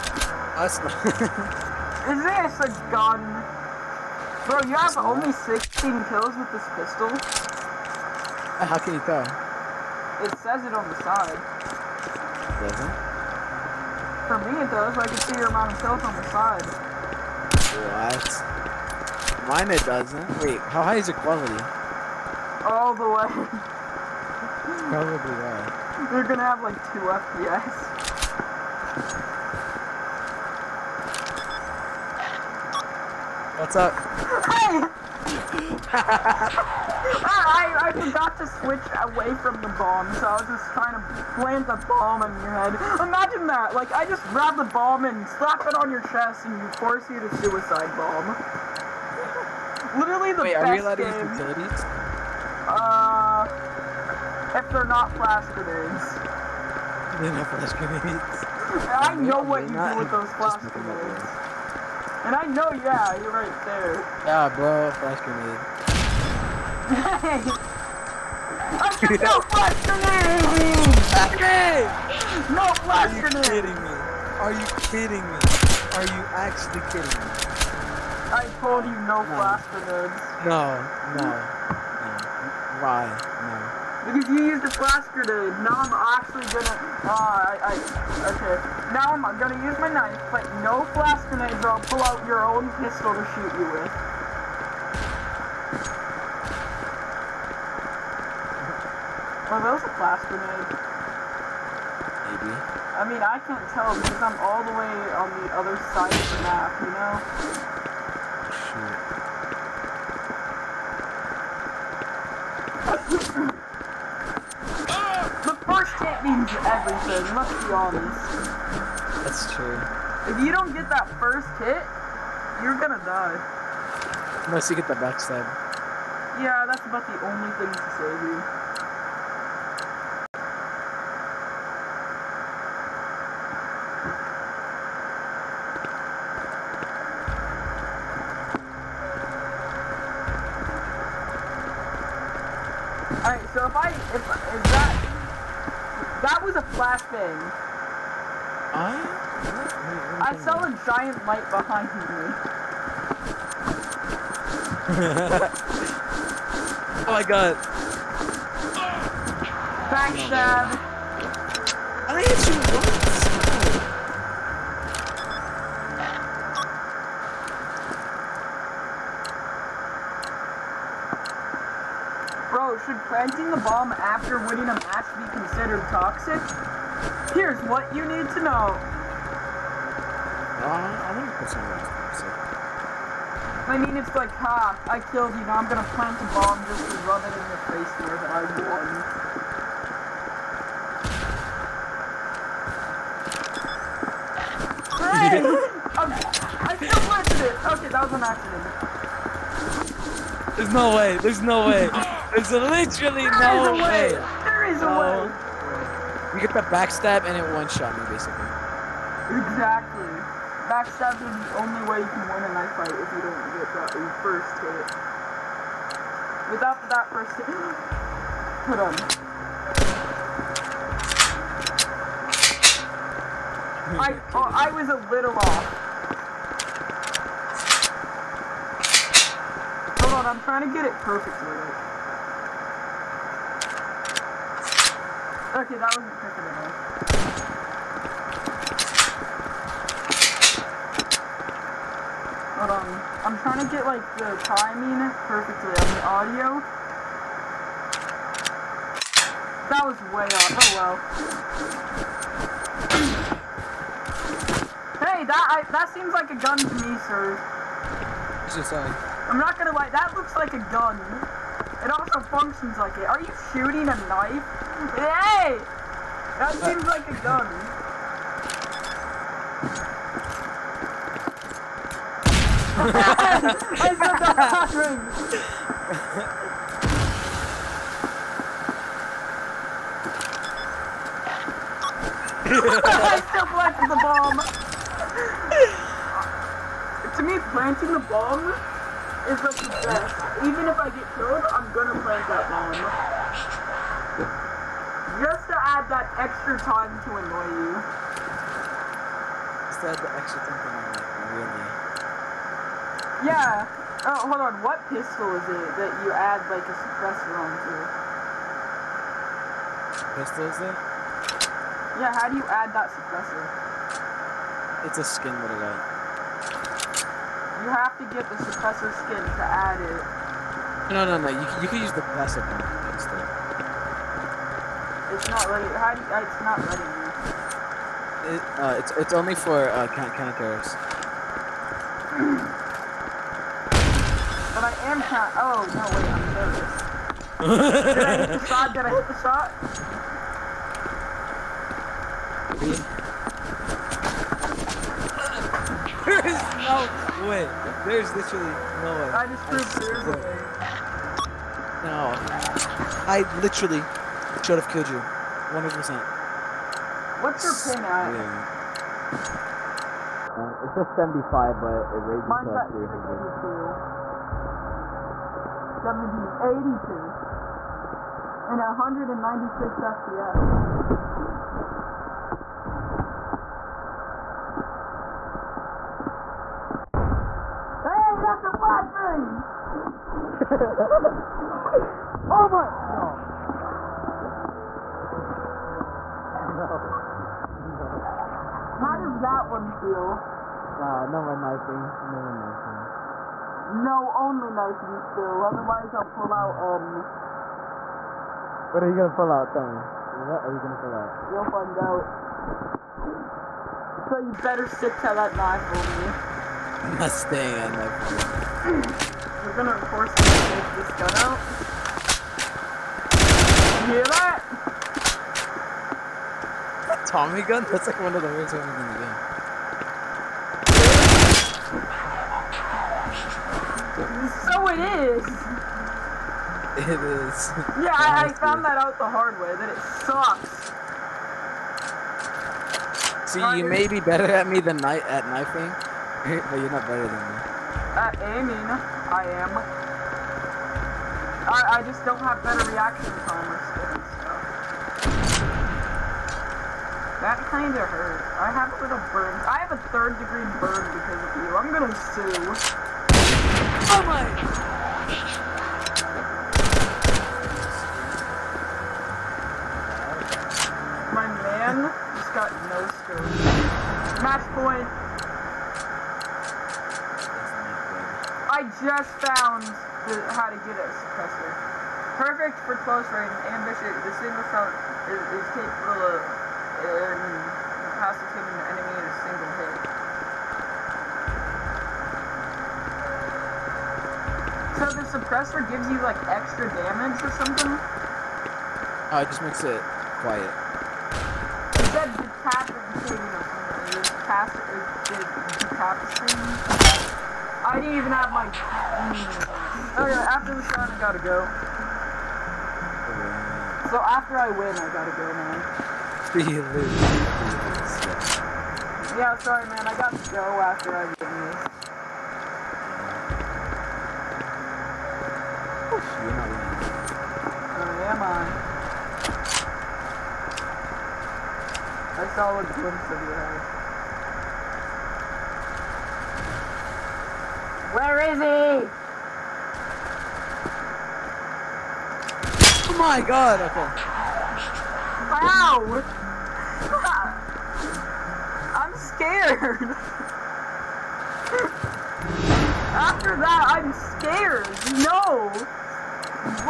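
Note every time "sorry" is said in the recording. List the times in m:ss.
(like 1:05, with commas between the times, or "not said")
8:29.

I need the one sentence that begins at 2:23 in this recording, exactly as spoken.
Alright, so if I if I that was a flashbang.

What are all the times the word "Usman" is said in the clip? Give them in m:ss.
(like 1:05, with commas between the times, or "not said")
not said.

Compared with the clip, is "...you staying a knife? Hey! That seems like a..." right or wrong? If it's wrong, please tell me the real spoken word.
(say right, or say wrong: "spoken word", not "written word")
wrong: "shooting", not "staying".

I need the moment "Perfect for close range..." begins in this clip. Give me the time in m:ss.
7:52.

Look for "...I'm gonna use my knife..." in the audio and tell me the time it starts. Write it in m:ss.
1:29.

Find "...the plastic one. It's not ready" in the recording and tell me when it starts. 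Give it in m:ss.
5:21.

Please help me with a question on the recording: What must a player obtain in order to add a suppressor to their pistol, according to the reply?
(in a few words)
Suppressor skin.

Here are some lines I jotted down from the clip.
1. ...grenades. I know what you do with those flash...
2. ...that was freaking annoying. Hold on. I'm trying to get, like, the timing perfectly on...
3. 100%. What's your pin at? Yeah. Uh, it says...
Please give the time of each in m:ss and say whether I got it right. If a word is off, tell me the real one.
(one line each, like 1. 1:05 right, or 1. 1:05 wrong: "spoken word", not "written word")
1. 0:57 right
2. 3:55 right
3. 5:54 right.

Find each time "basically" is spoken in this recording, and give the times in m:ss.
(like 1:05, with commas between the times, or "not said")
3:28.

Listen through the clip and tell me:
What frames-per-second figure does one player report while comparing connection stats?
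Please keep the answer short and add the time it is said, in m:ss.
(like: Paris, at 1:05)
196, at 6:08.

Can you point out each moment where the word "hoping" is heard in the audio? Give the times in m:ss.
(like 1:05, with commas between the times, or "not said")
not said.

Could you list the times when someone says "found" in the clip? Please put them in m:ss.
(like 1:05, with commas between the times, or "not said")
7:08, 7:49.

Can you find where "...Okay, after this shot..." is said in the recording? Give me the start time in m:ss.
8:20.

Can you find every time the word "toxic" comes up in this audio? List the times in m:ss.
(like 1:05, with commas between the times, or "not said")
2:55, 3:01.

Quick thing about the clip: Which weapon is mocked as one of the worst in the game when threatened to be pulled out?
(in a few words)
Tommy gun.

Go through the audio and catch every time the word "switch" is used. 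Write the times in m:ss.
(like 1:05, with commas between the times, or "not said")
0:38.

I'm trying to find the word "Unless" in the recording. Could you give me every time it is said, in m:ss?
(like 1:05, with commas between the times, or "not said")
2:04.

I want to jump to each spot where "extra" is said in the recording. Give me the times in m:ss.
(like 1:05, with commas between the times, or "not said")
4:56, 5:00, 8:06.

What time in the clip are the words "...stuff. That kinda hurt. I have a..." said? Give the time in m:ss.
7:23.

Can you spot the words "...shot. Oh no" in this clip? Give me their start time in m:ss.
5:35.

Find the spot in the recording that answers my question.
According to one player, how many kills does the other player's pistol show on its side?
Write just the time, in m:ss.
0:05.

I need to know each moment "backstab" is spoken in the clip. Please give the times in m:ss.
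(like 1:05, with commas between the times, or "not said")
2:04, 2:39, 3:26, 3:30.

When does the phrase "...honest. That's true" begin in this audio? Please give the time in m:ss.
1:57.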